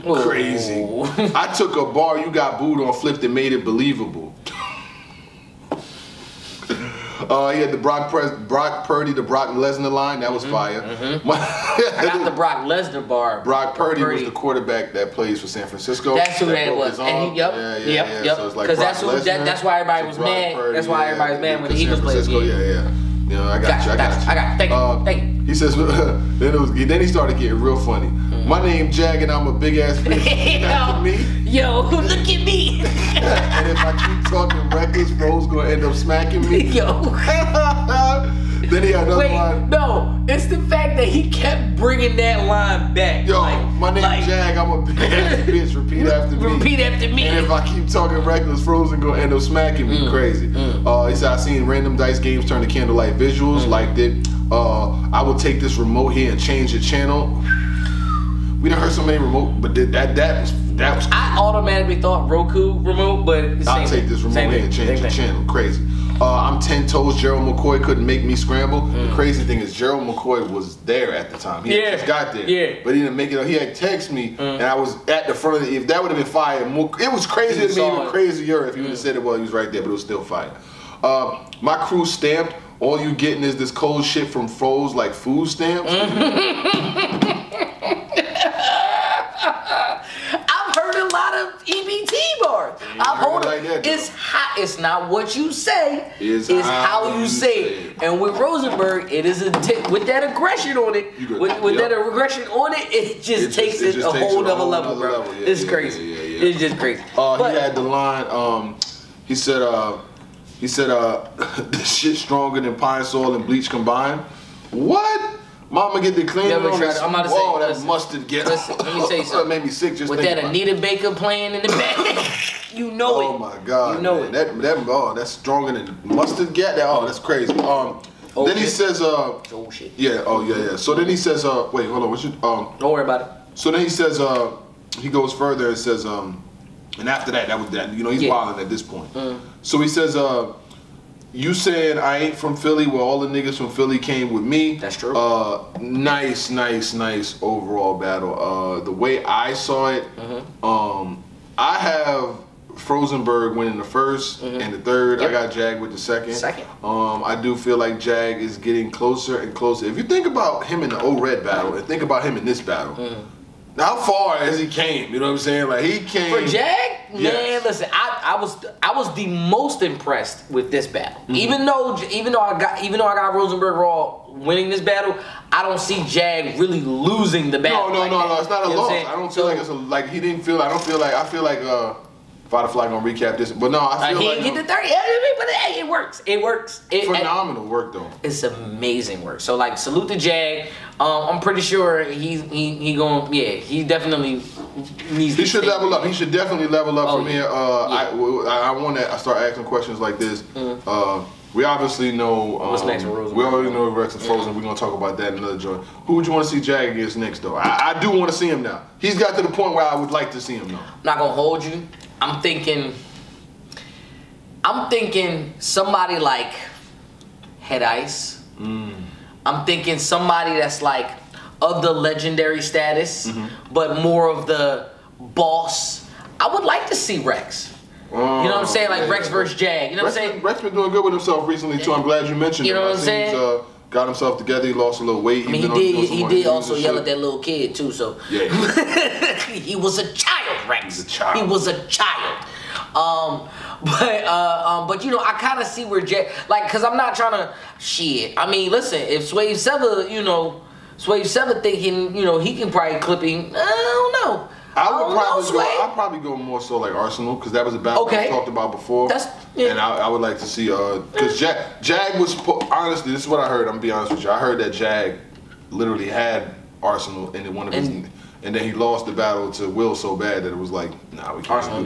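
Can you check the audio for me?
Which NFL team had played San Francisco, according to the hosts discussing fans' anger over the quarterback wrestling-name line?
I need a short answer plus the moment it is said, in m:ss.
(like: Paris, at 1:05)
Eagles, at 0:21.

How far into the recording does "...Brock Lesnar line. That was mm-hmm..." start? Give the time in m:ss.
0:09.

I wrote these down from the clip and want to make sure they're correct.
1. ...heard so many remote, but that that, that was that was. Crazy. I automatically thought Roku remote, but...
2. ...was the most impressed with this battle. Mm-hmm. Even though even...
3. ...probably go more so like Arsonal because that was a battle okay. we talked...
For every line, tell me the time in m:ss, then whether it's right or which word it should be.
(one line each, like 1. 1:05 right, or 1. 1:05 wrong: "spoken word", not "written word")
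1. 0:58 right
2. 2:48 right
3. 4:15 right.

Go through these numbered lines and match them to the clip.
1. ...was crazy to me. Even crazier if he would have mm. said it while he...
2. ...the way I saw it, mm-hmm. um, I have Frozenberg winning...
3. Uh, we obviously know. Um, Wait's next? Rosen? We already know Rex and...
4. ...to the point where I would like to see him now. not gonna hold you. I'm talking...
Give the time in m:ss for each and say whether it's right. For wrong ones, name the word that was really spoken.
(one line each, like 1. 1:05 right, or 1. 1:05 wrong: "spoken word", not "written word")
1. 1:17 right
2. 2:28 right
3. 3:20 wrong: "What", not "Wait"
4. 3:29 wrong: "thinking", not "talking".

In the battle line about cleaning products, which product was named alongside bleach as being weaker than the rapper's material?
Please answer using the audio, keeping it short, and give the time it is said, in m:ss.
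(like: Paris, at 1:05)
Pine Sol, at 1:52.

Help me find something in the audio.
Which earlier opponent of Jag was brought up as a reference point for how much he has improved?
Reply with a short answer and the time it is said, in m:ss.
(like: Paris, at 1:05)
O Red, at 2:41.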